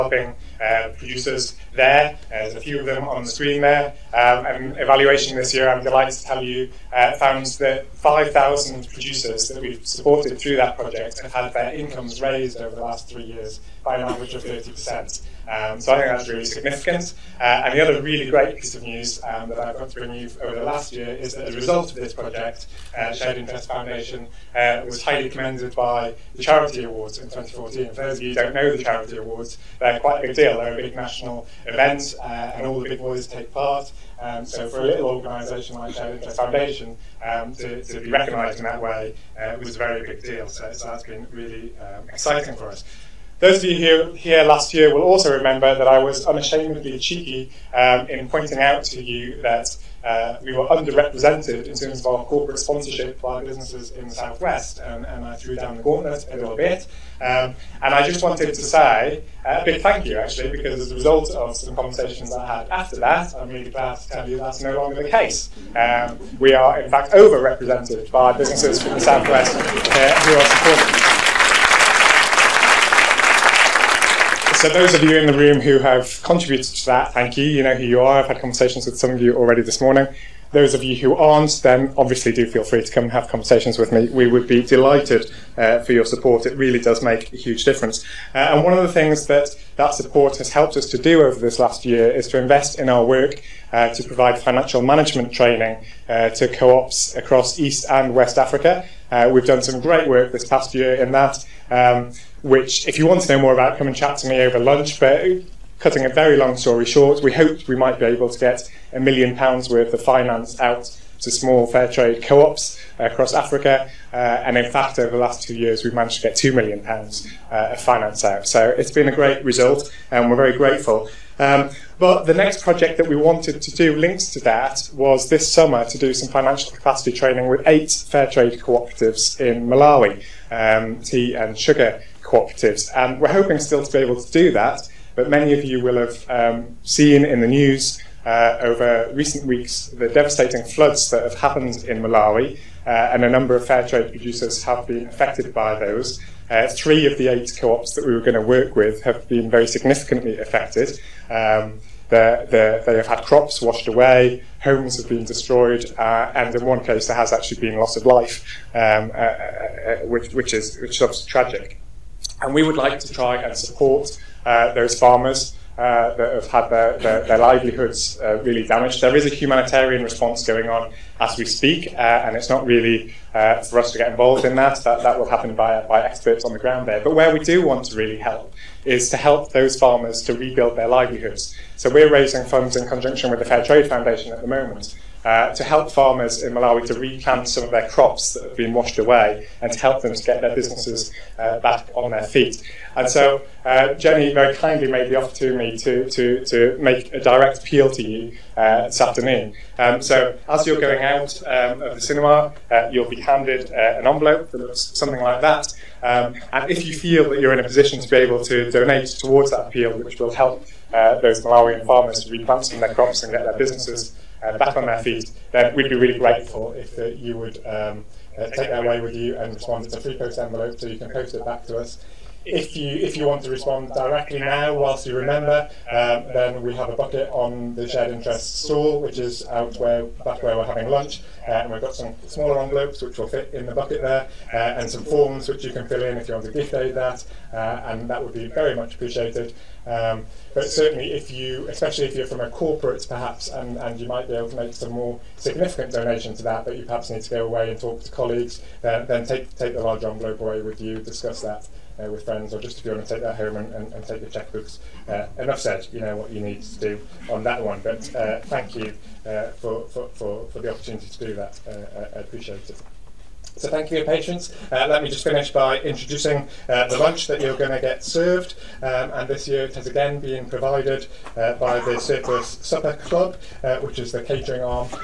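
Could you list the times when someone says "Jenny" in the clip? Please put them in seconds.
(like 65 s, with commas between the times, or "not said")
193 s.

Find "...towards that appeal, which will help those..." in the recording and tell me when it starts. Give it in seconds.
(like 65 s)
209 s.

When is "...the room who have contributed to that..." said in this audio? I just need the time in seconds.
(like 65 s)
75 s.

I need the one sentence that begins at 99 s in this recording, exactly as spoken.
Uh, we've done some great work this past year in that.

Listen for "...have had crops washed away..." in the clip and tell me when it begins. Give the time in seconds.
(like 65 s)
152 s.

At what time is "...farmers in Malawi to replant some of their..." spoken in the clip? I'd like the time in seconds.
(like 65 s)
185 s.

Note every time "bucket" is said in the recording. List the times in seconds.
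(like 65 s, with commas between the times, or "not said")
226 s, 233 s.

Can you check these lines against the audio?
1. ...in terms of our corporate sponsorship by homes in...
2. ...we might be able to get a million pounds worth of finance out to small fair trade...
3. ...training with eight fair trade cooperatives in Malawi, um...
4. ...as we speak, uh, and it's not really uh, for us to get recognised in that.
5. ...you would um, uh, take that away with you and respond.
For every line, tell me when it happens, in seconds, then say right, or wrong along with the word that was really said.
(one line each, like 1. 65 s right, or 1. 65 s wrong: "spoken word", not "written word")
1. 51 s wrong: "businesses", not "homes"
2. 107 s right
3. 127 s right
4. 171 s wrong: "involved", not "recognised"
5. 217 s right.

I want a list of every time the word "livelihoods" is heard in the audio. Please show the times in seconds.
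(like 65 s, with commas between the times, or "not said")
167 s, 180 s.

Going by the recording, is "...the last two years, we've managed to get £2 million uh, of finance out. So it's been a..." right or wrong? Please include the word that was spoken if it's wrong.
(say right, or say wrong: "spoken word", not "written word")
right.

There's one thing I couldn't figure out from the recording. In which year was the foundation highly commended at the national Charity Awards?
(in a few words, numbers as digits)
2014.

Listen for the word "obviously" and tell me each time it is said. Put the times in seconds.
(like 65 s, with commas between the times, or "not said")
81 s, 161 s.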